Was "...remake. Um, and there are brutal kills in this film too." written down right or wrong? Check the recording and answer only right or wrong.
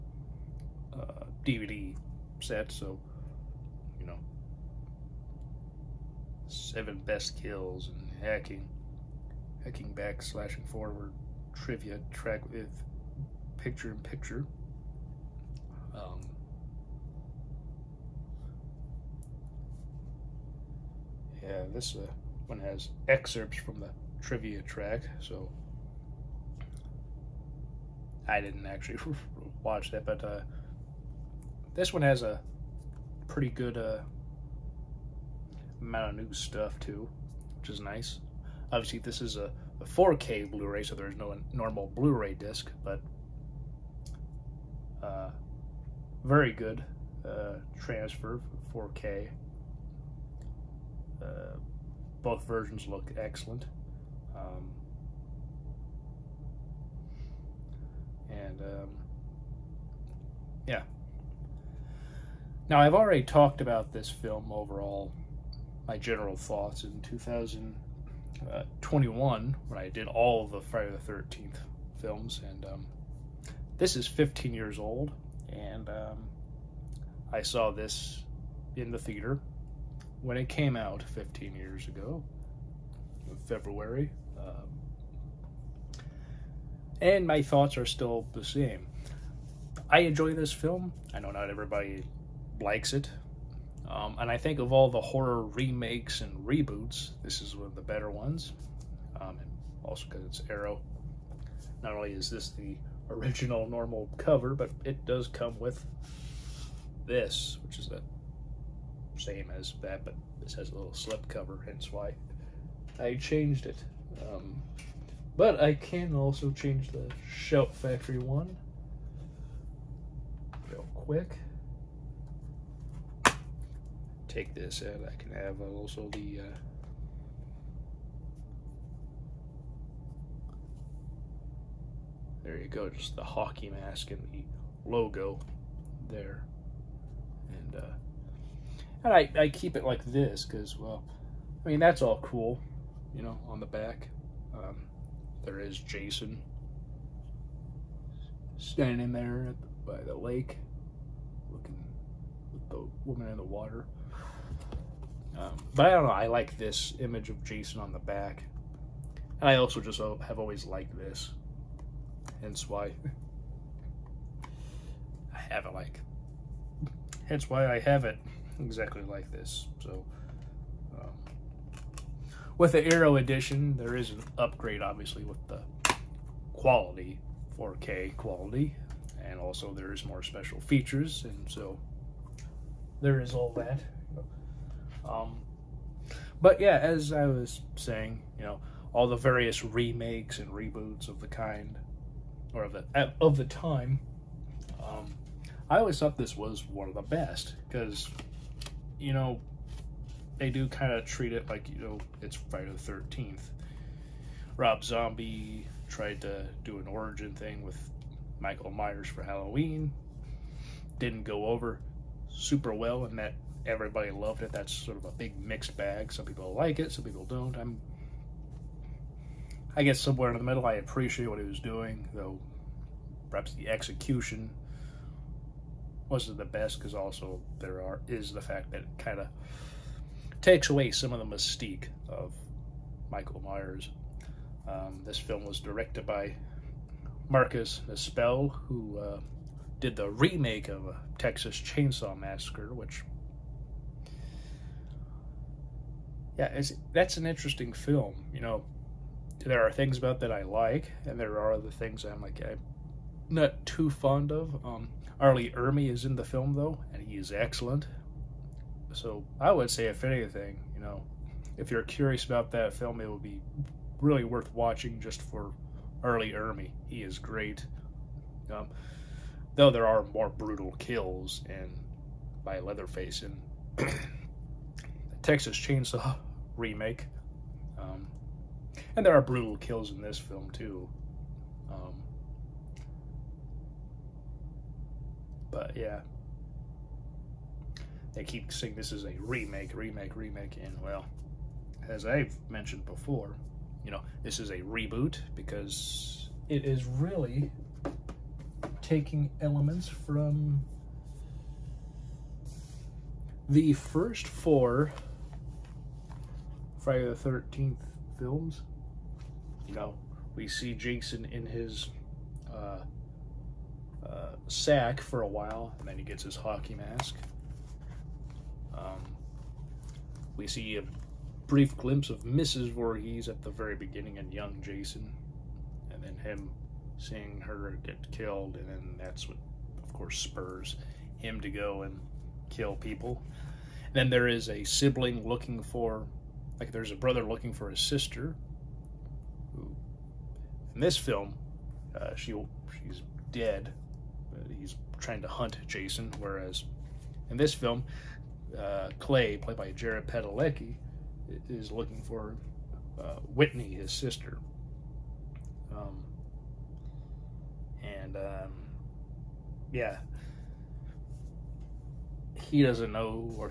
right.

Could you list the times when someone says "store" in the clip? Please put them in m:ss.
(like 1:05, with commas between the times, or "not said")
not said.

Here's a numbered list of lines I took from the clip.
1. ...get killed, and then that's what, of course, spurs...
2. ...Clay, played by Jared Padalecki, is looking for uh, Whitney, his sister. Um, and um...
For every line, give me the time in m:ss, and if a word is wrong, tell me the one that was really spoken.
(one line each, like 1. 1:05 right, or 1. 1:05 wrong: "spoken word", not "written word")
1. 5:27 right
2. 5:48 right.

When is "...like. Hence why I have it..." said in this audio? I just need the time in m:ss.
2:45.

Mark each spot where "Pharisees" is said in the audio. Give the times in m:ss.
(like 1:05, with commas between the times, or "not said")
not said.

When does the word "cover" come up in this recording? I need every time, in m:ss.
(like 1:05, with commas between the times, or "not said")
1:44, 1:51.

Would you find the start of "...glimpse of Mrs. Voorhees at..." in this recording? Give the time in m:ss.
5:21.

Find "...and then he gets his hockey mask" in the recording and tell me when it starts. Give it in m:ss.
5:15.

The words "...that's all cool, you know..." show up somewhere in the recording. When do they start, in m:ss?
2:21.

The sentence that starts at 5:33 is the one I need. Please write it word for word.
And then there is a sibling looking for, like, there's a brother looking for his sister.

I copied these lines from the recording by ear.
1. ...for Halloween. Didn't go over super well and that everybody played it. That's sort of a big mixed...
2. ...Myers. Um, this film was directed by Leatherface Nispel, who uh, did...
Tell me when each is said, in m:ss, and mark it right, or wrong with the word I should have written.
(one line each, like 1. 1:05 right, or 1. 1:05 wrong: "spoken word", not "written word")
1. 3:29 wrong: "loved", not "played"
2. 3:53 wrong: "Marcus", not "Leatherface".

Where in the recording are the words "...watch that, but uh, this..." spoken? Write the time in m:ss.
0:29.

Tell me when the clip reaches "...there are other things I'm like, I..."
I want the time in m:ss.
4:11.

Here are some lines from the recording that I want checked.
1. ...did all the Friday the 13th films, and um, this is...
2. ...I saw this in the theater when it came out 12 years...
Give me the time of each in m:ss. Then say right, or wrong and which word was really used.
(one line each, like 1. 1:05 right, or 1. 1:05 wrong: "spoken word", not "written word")
1. 1:09 right
2. 1:17 wrong: "15", not "12".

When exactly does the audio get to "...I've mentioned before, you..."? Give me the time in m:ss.
4:52.